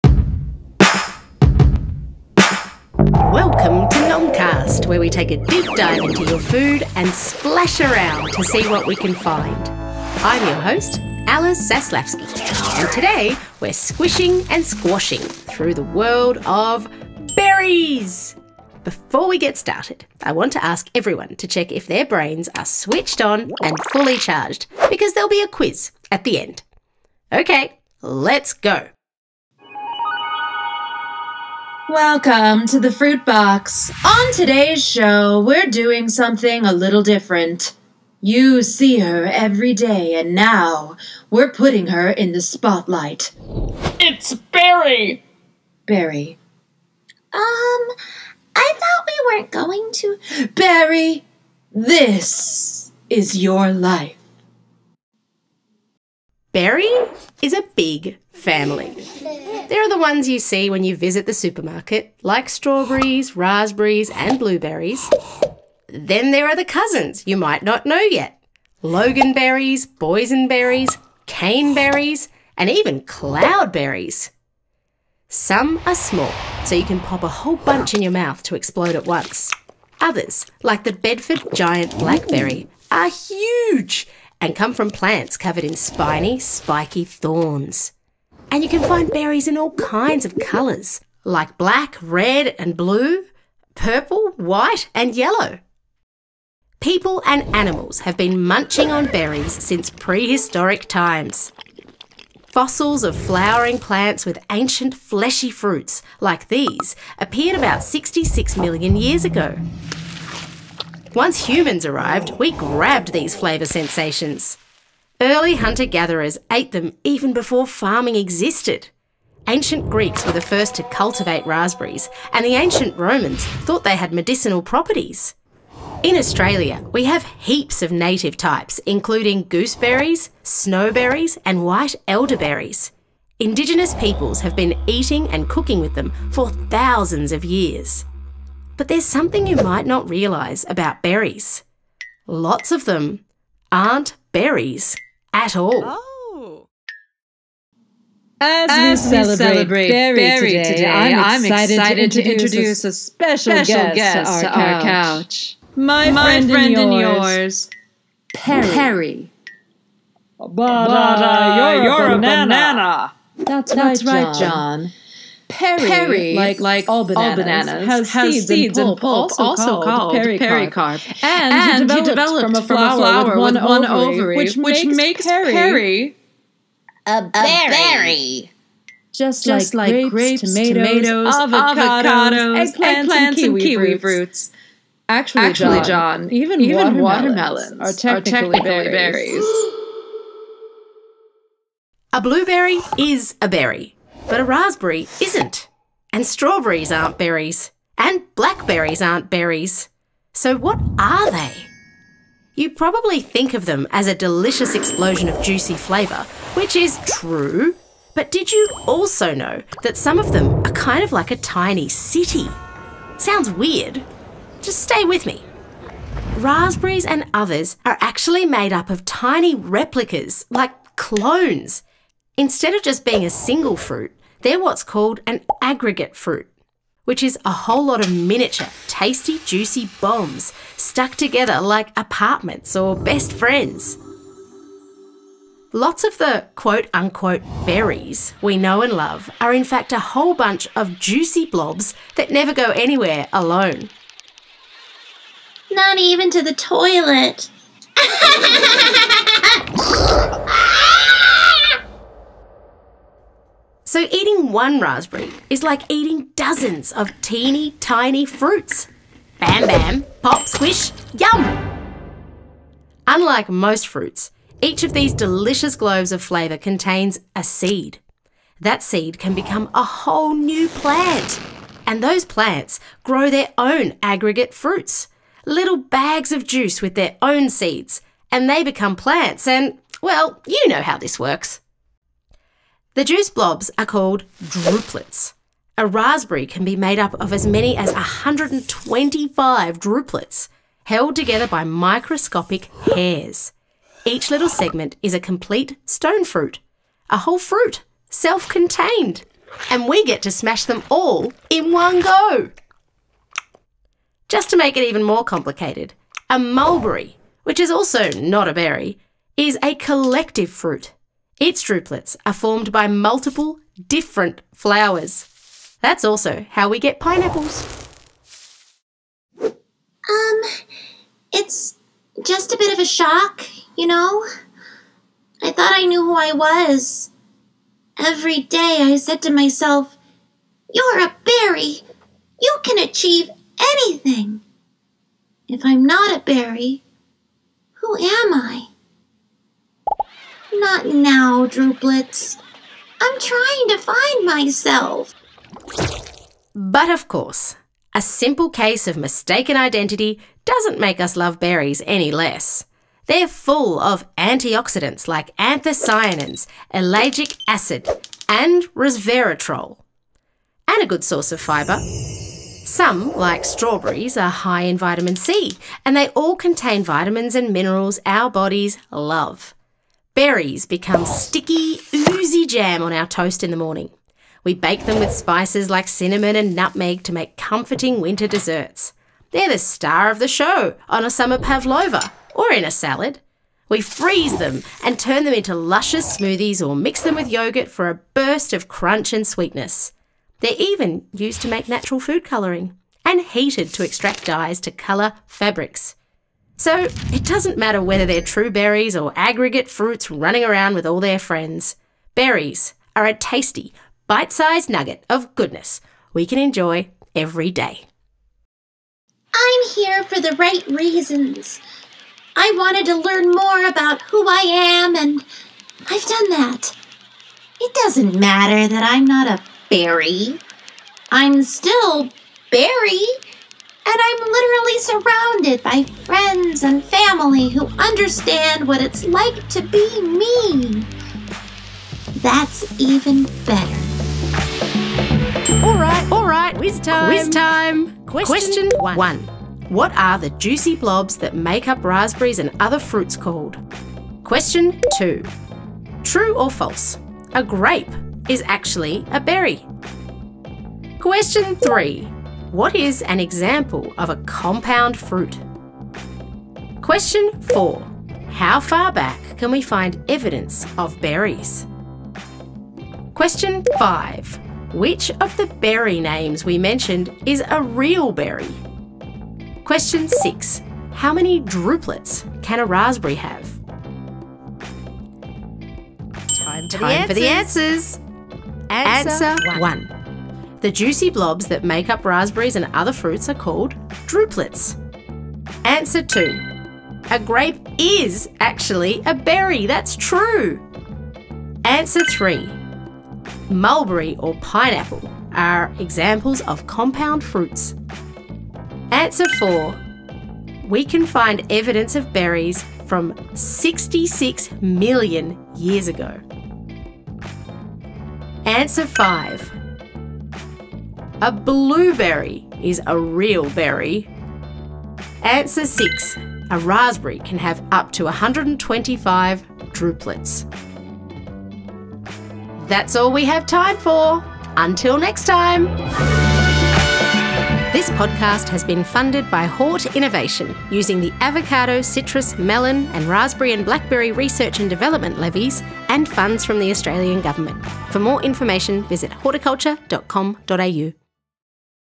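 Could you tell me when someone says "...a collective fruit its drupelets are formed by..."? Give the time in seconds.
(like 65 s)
309 s.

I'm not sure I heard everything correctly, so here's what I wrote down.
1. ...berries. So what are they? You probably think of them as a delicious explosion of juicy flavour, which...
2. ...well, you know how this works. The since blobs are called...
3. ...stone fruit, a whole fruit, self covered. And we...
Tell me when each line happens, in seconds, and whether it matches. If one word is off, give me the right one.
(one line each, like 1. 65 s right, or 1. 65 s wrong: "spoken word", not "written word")
1. 199 s right
2. 280 s wrong: "juice", not "since"
3. 295 s wrong: "contained", not "covered".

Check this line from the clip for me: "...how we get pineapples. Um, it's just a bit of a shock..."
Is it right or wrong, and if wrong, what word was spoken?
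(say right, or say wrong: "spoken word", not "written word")
right.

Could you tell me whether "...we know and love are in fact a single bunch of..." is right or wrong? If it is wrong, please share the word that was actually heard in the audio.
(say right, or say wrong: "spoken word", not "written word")
wrong: "whole", not "single".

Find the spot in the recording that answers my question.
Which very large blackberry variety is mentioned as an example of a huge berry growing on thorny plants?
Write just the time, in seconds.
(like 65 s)
80 s.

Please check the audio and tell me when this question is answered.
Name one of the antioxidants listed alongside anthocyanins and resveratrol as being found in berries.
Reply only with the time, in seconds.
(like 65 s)
356 s.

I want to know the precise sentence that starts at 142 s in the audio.
Lots of them aren't berries at all.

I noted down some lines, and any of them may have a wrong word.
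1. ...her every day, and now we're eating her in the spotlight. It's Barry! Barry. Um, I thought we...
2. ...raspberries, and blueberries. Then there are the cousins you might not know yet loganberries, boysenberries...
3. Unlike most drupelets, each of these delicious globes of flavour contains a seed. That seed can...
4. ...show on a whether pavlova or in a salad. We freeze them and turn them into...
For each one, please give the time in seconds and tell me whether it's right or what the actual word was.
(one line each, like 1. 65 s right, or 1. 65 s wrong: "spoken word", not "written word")
1. 38 s wrong: "putting", not "eating"
2. 63 s right
3. 263 s wrong: "fruits", not "drupelets"
4. 380 s wrong: "summer", not "whether".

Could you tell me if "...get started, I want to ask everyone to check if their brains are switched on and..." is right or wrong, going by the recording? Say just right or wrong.
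right.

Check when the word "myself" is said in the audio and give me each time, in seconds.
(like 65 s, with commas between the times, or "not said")
329 s, 344 s.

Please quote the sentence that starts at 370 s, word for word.
Berries become sticky, oozy jam on our toast in the morning.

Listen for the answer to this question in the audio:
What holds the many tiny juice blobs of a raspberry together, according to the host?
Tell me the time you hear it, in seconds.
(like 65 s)
291 s.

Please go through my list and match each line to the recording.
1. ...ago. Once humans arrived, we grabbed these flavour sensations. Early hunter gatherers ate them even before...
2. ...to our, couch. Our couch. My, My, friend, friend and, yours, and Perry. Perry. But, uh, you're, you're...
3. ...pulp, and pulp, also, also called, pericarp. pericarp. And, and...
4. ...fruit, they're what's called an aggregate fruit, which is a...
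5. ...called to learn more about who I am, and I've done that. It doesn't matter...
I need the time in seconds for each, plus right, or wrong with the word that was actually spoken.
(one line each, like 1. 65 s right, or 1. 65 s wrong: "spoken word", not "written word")
1. 109 s right
2. 154 s right
3. 168 s right
4. 223 s right
5. 412 s wrong: "wanted", not "called".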